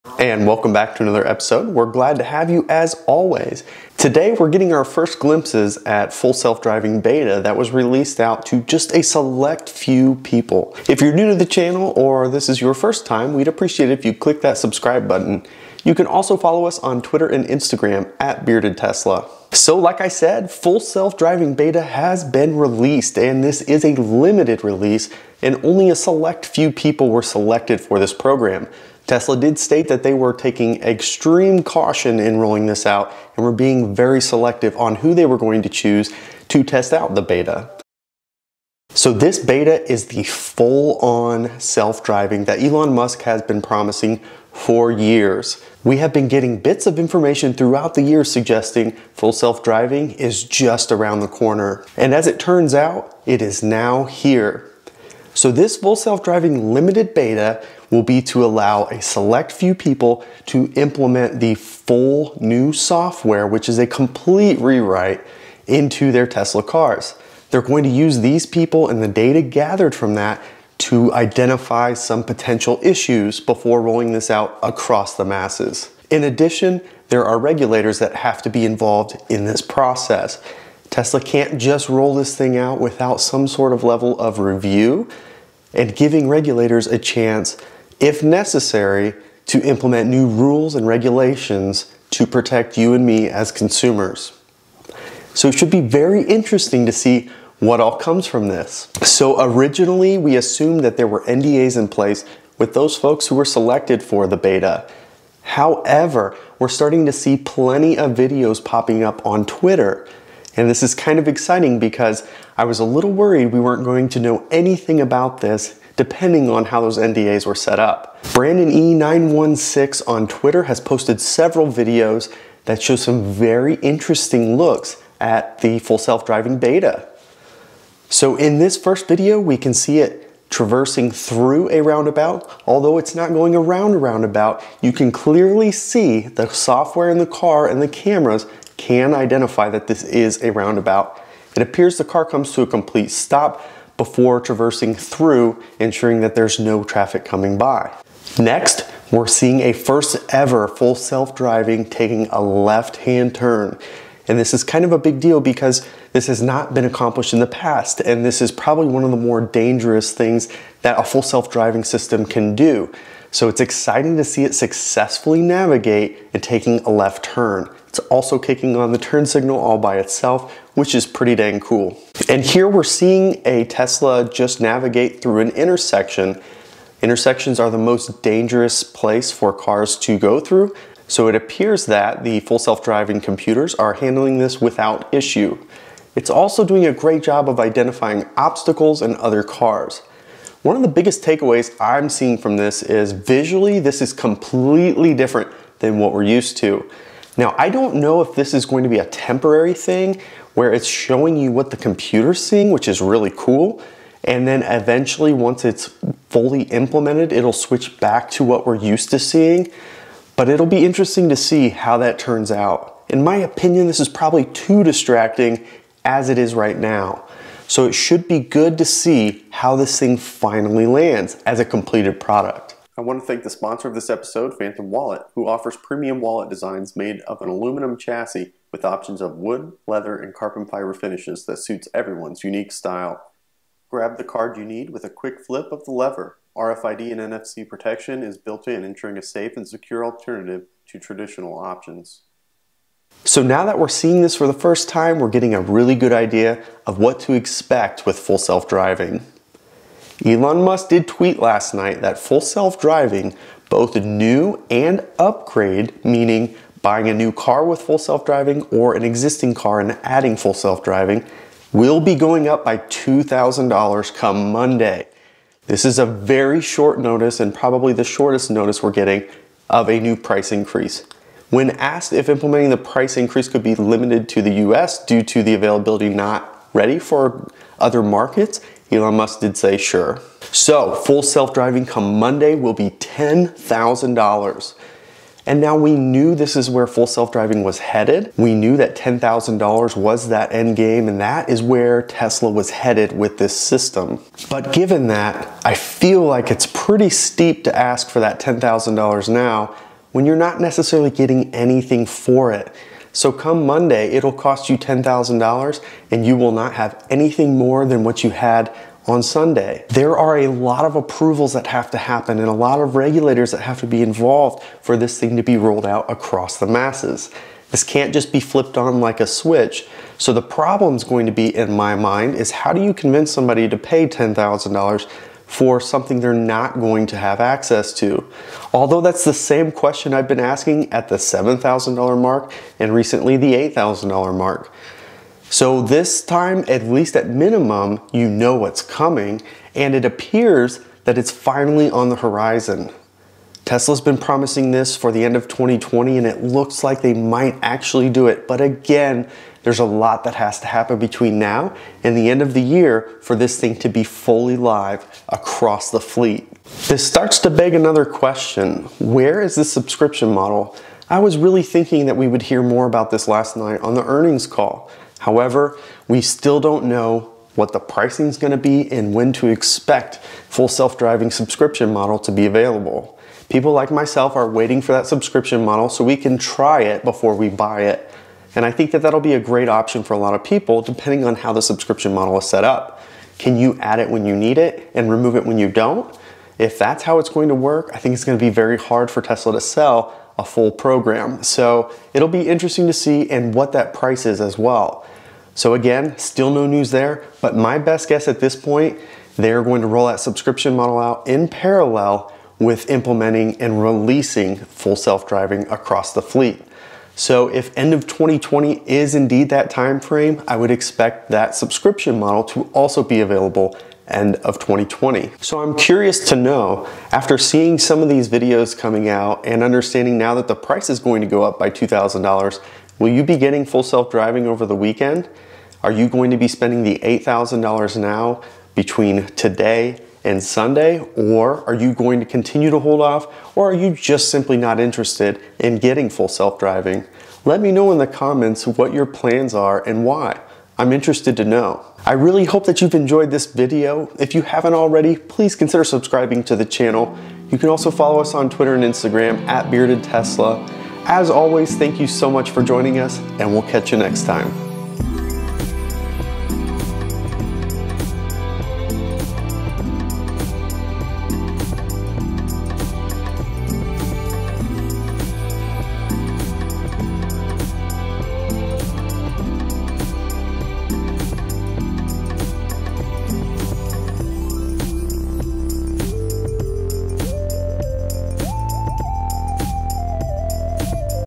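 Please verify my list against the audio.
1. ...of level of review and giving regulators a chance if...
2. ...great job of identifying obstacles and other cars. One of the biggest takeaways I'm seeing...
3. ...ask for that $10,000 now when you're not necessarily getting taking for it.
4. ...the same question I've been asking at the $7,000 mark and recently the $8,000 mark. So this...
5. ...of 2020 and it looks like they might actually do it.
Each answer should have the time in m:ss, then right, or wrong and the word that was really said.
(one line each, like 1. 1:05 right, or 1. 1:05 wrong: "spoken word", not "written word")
1. 1:23 right
2. 3:06 right
3. 4:57 wrong: "anything", not "taking"
4. 5:29 right
5. 5:45 right.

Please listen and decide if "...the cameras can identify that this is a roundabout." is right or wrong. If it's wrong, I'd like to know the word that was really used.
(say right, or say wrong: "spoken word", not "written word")
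right.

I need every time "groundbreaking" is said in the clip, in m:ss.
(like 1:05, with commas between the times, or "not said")
not said.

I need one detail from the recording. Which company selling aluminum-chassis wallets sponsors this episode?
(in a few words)
Fantom Wallet.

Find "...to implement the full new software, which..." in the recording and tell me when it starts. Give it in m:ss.
1:00.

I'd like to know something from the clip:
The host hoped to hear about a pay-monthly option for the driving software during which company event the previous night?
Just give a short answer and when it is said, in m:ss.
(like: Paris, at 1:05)
Earnings call, at 6:04.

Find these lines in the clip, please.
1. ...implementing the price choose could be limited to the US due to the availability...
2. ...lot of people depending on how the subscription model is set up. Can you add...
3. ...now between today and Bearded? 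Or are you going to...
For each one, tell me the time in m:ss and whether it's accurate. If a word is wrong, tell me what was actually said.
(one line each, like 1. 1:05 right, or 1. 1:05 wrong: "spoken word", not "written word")
1. 4:32 wrong: "increase", not "choose"
2. 6:20 right
3. 7:07 wrong: "Sunday", not "Bearded".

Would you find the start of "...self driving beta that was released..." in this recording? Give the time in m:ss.
0:06.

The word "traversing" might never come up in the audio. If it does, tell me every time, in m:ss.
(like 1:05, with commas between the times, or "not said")
2:10, 2:24.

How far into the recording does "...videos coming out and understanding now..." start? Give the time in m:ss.
6:58.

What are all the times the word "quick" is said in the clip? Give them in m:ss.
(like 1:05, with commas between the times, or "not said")
3:55.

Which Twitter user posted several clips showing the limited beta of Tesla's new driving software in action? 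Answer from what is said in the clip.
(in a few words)
Brandon E916.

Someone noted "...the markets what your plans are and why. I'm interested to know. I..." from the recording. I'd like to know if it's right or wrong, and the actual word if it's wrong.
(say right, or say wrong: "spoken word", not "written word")
wrong: "comments", not "markets".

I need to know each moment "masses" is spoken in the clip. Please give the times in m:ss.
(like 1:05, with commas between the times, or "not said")
1:15, 5:16.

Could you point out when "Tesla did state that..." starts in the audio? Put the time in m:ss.
0:29.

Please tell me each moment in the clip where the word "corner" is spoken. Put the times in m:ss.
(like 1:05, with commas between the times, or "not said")
0:51.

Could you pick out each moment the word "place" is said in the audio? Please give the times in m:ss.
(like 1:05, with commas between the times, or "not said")
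1:41, 2:58.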